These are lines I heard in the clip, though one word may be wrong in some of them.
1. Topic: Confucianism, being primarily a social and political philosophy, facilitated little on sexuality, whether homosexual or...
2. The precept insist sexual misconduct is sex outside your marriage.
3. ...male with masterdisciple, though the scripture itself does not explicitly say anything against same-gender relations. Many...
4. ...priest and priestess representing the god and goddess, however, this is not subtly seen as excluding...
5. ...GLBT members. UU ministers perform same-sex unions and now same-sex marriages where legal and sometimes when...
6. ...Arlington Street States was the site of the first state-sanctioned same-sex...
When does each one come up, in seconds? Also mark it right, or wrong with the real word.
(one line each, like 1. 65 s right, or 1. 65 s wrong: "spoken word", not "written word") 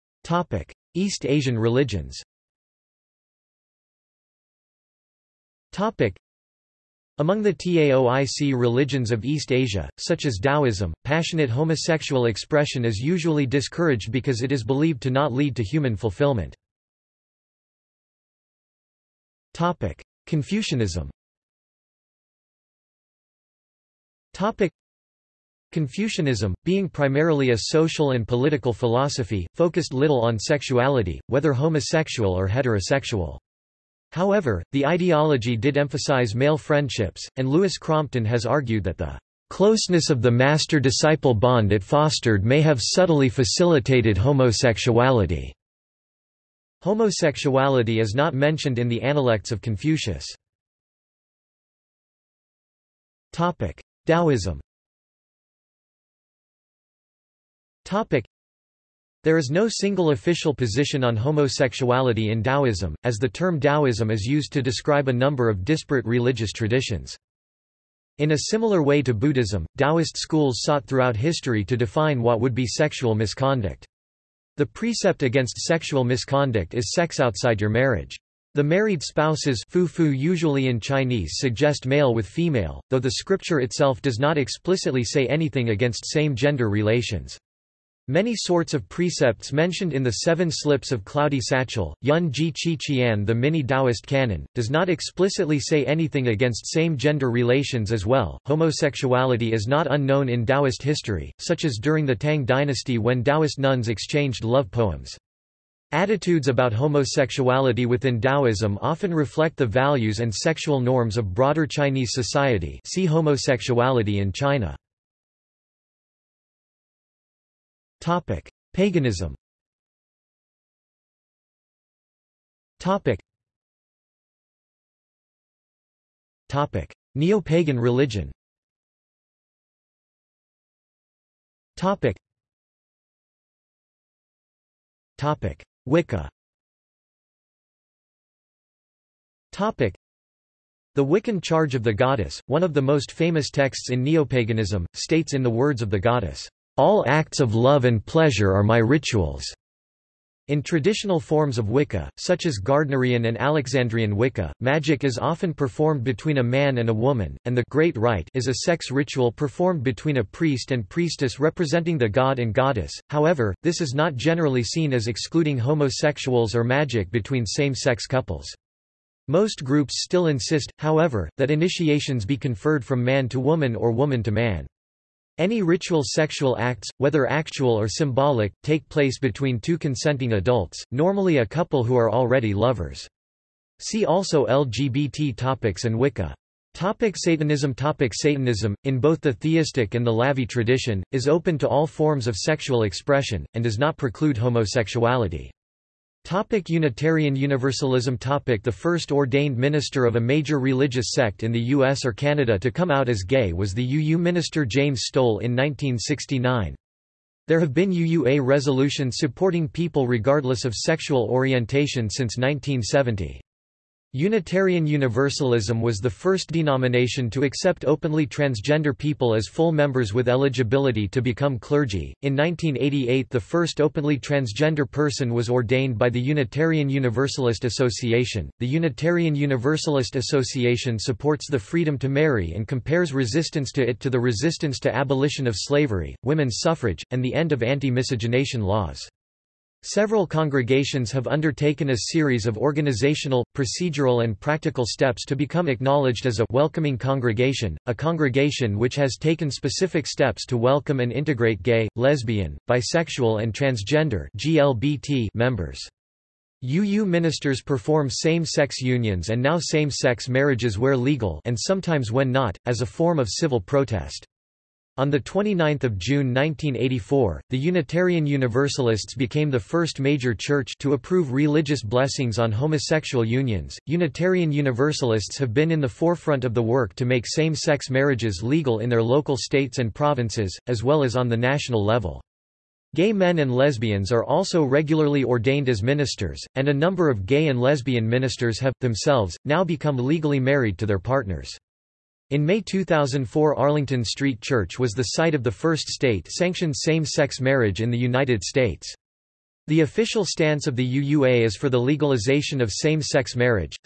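1. 24 s wrong: "focused", not "facilitated"
2. 74 s wrong: "against", not "insist"
3. 81 s wrong: "female", not "masterdisciple"
4. 160 s wrong: "generally", not "subtly"
5. 254 s right
6. 293 s wrong: "Church", not "States".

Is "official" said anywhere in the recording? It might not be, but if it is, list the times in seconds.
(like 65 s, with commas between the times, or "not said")
60 s, 299 s.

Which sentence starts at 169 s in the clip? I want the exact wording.
Most groups still insist, however, that initiations be conferred from man to woman or woman to man.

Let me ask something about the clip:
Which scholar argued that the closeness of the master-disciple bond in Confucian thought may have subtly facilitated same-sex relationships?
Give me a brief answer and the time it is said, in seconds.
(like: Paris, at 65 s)
Louis Crompton, at 37 s.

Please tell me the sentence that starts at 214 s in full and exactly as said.
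Unitarian Universalism was the first denomination to accept openly transgender people as full members with eligibility to become clergy.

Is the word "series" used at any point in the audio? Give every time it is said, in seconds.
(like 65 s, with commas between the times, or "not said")
242 s.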